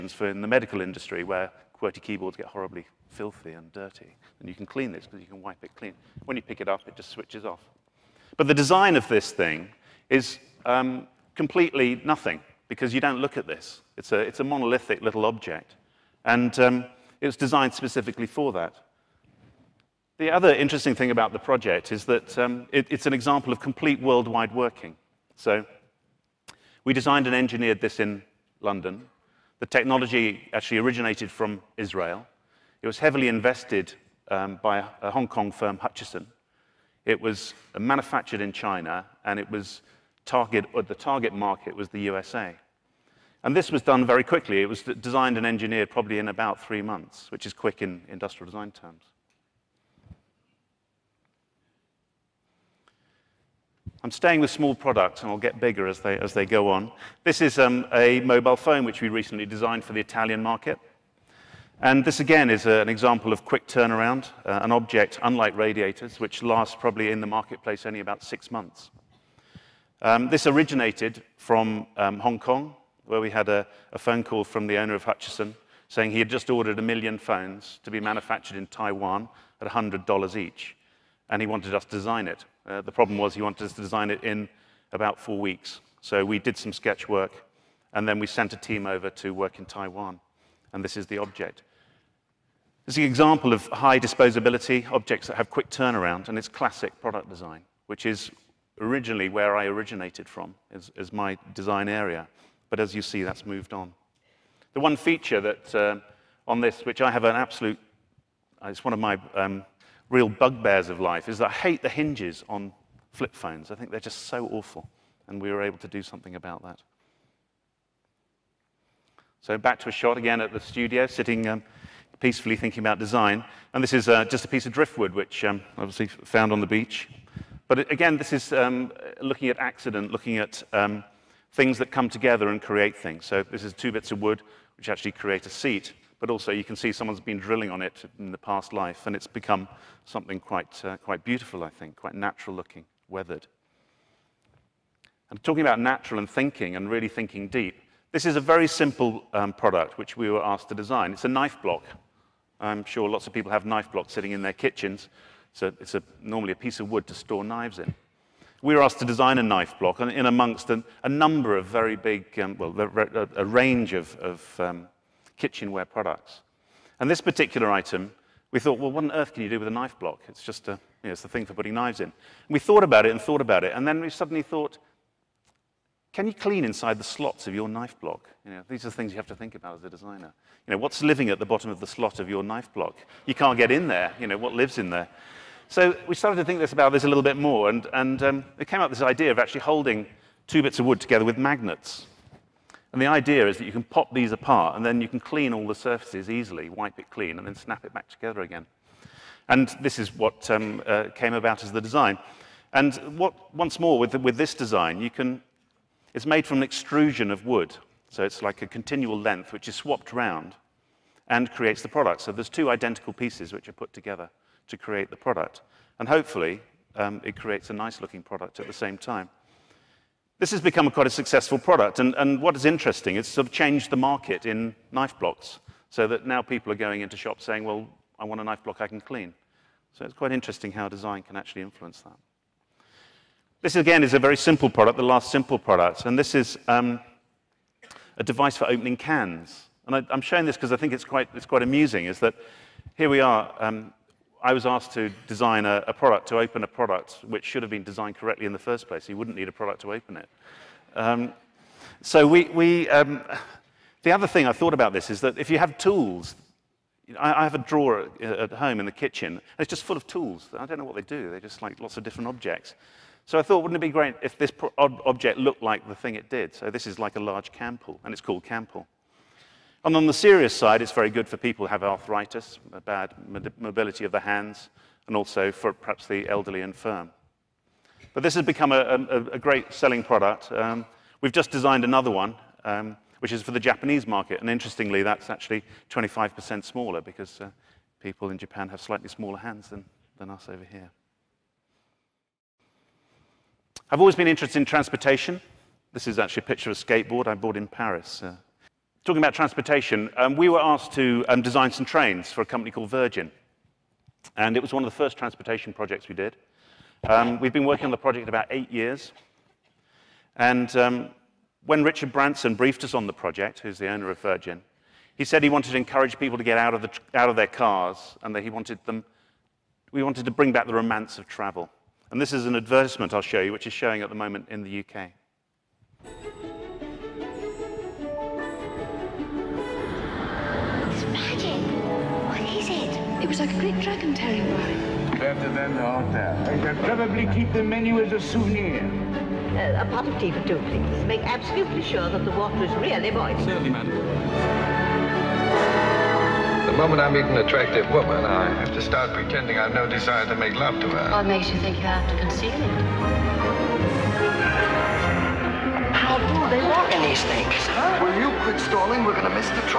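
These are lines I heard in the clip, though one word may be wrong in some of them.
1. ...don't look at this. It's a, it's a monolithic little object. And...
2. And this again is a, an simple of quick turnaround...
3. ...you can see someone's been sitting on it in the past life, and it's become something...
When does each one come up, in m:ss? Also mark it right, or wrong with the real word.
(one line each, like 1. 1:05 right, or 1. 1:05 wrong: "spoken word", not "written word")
1. 0:13 right
2. 1:01 wrong: "example", not "simple"
3. 2:16 wrong: "drilling", not "sitting".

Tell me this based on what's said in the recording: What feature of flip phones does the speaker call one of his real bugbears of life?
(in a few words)
The hinges.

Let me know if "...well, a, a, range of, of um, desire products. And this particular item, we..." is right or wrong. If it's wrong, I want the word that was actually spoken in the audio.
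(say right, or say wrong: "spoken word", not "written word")
wrong: "kitchenware", not "desire".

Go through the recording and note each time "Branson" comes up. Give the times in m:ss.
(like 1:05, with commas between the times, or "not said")
5:12.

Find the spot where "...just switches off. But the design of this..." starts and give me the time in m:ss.
0:06.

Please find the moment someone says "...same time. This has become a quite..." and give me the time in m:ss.
3:38.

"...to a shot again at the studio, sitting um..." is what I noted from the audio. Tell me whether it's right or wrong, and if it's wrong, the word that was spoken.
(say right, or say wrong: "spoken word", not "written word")
right.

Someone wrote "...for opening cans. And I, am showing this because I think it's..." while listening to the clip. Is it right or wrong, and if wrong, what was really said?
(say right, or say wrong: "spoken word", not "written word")
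right.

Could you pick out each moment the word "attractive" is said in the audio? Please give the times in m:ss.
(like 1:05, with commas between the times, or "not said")
5:47.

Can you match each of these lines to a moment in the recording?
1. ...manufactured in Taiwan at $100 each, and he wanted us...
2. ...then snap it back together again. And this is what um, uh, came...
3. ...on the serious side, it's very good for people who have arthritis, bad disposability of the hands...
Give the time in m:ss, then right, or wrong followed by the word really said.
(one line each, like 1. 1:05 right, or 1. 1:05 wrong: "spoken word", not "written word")
1. 1:17 right
2. 3:17 right
3. 4:29 wrong: "mobility", not "disposability".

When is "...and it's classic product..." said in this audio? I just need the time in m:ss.
1:36.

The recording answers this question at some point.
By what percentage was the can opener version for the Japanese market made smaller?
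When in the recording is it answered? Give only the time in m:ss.
4:45.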